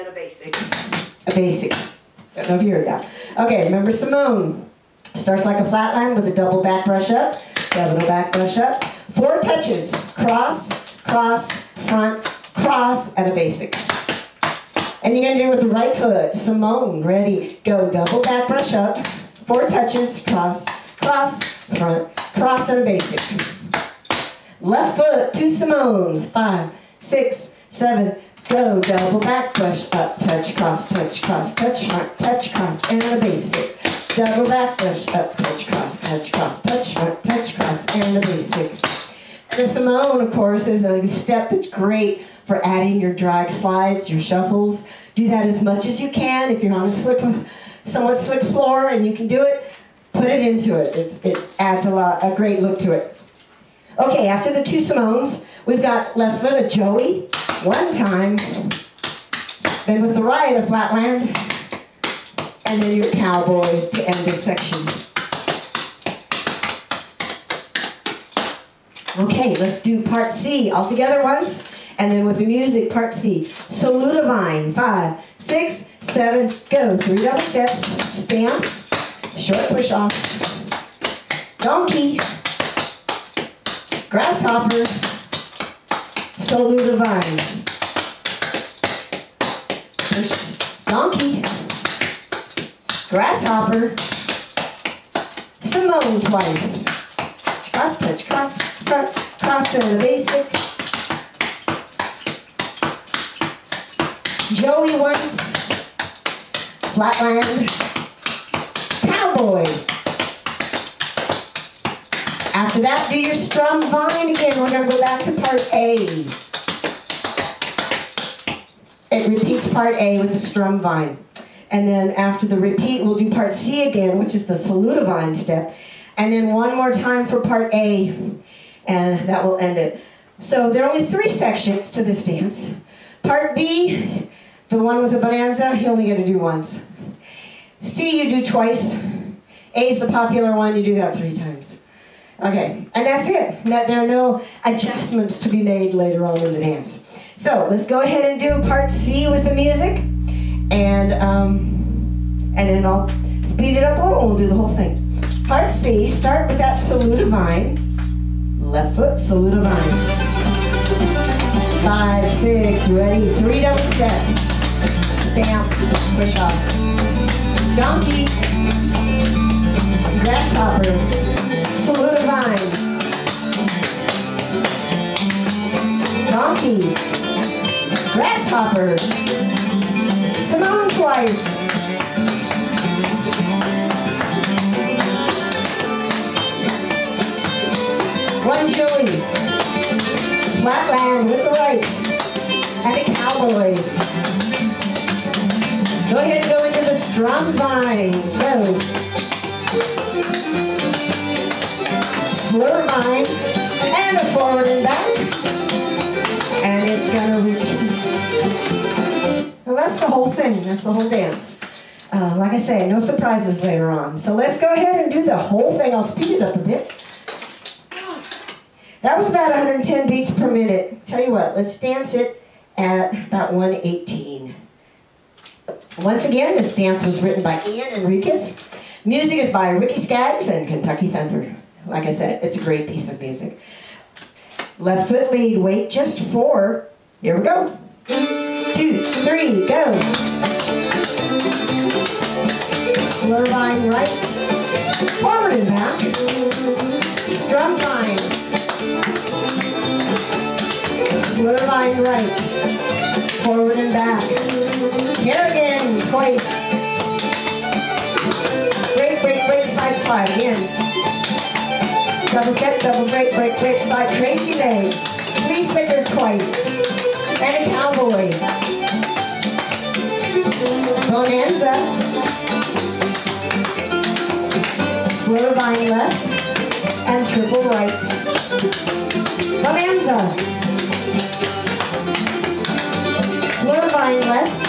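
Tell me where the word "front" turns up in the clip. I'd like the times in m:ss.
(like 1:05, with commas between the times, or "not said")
0:11, 0:21, 0:31, 0:36, 1:38.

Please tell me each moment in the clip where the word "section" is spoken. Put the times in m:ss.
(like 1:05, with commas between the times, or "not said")
1:04, 2:11.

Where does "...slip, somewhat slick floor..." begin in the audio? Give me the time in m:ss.
0:46.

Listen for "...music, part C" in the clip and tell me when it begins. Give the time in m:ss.
1:12.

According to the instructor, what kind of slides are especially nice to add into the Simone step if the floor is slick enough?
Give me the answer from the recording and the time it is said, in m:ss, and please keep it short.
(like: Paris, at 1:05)
drag slides, at 0:43.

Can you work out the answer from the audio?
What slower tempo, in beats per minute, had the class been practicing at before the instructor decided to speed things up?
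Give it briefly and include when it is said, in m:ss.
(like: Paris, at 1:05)
110, at 3:39.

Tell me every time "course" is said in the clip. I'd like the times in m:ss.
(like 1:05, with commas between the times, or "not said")
0:40.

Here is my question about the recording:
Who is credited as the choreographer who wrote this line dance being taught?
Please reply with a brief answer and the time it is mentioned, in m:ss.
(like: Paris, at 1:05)
Ian Enriquez, at 3:47.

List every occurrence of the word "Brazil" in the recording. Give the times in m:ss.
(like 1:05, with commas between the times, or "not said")
not said.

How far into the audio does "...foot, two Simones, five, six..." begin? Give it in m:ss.
0:24.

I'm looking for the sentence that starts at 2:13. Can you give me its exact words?
Part B, the one with the bonanza, you only get to do once.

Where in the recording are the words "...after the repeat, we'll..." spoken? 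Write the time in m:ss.
2:02.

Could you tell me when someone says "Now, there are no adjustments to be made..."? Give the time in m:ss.
2:23.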